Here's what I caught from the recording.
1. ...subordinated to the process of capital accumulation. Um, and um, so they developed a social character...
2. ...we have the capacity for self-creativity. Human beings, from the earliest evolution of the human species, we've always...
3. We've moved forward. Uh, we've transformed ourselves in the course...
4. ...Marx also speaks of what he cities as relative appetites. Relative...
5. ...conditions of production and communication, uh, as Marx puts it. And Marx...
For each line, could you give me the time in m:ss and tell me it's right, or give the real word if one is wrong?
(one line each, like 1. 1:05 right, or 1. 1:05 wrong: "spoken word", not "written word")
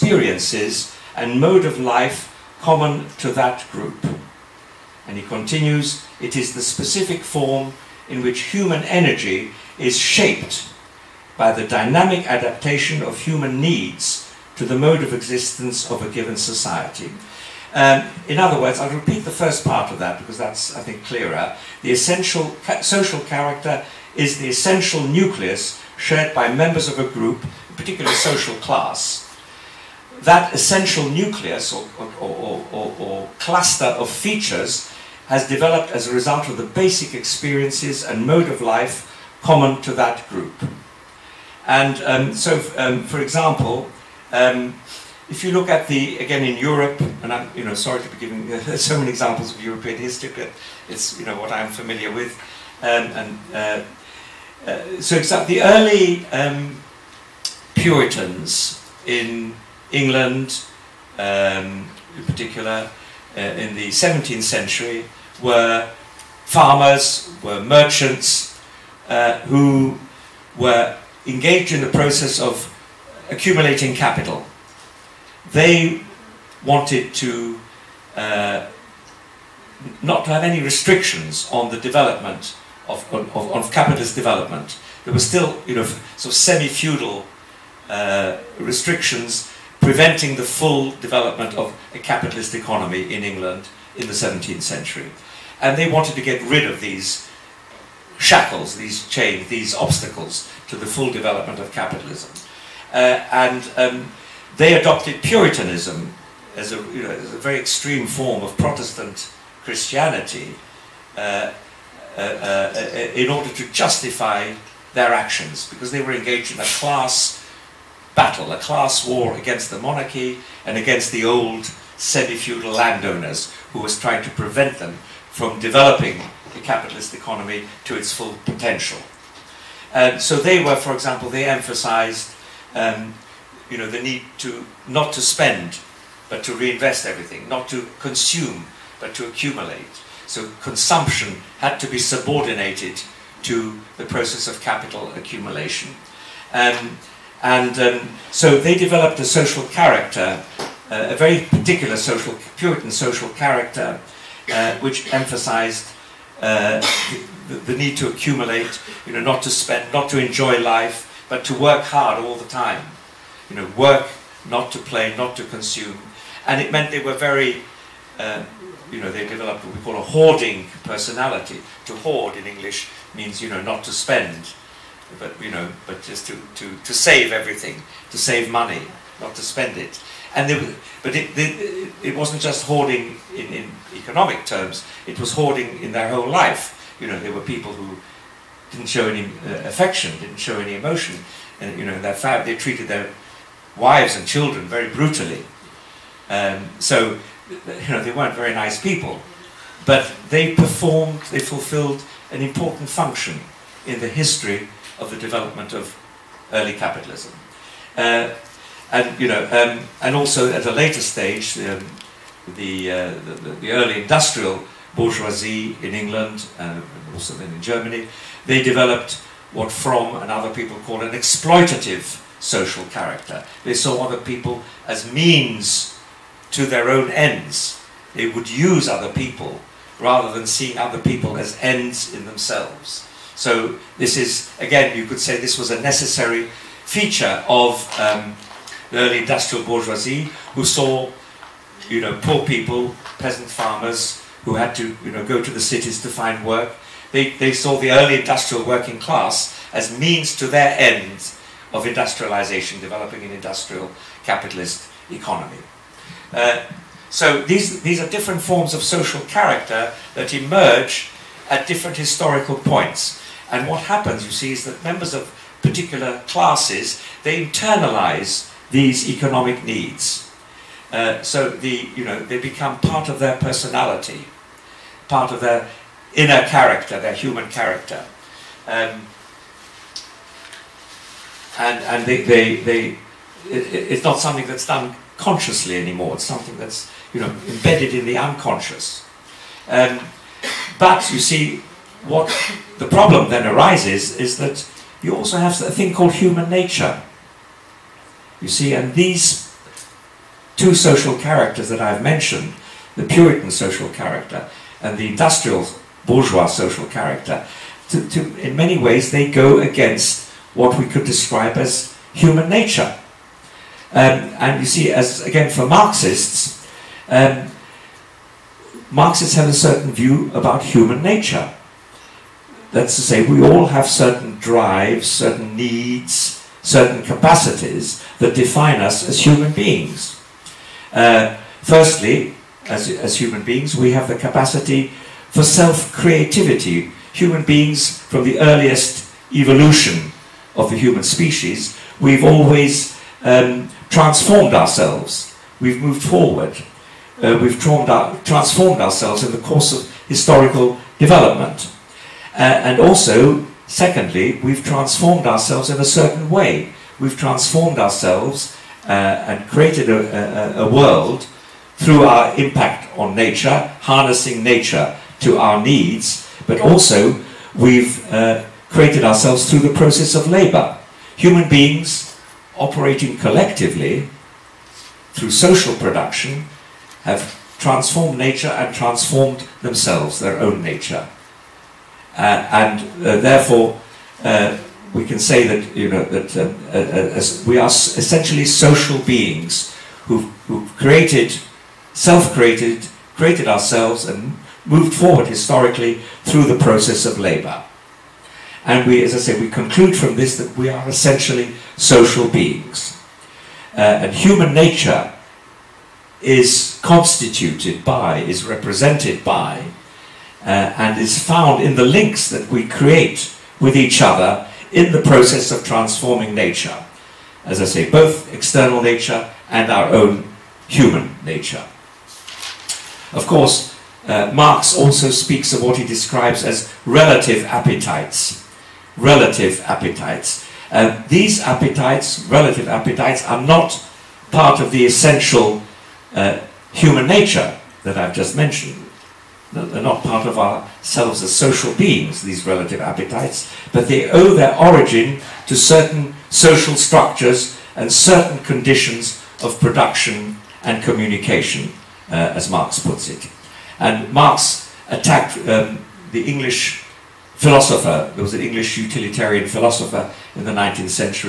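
1. 2:21 right
2. 5:33 right
3. 5:45 right
4. 7:04 wrong: "describes", not "cities"
5. 7:28 right.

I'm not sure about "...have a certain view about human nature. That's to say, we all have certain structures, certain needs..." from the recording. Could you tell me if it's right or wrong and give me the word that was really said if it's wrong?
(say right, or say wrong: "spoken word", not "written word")
wrong: "drives", not "structures".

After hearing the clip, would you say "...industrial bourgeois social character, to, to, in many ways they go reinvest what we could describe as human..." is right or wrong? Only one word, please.
wrong.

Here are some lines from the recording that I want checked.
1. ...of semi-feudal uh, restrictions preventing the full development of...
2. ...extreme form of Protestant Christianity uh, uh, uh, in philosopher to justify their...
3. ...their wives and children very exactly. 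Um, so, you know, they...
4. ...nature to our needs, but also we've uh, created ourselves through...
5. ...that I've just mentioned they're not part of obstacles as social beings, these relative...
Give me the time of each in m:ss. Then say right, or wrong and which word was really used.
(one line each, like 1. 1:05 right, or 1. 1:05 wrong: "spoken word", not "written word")
1. 1:26 right
2. 1:47 wrong: "order", not "philosopher"
3. 3:12 wrong: "brutally", not "exactly"
4. 6:04 right
5. 7:17 wrong: "ourselves", not "obstacles".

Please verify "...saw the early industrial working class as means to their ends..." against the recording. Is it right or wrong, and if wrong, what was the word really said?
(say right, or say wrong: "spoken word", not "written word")
right.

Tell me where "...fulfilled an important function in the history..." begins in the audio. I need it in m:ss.
3:21.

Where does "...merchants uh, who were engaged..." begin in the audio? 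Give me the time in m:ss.
1:07.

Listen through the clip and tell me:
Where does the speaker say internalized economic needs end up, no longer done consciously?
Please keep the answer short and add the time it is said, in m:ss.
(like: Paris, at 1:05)
The unconscious, at 4:48.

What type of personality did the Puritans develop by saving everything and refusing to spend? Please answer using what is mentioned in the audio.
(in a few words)
Hoarding personality.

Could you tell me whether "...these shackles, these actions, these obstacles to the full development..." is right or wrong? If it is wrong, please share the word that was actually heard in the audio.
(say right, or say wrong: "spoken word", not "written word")
wrong: "chains", not "actions".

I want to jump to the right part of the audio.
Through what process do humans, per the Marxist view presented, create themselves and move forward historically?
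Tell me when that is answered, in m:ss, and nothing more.
6:37.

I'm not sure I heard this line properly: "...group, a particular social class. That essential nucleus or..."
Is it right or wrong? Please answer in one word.
right.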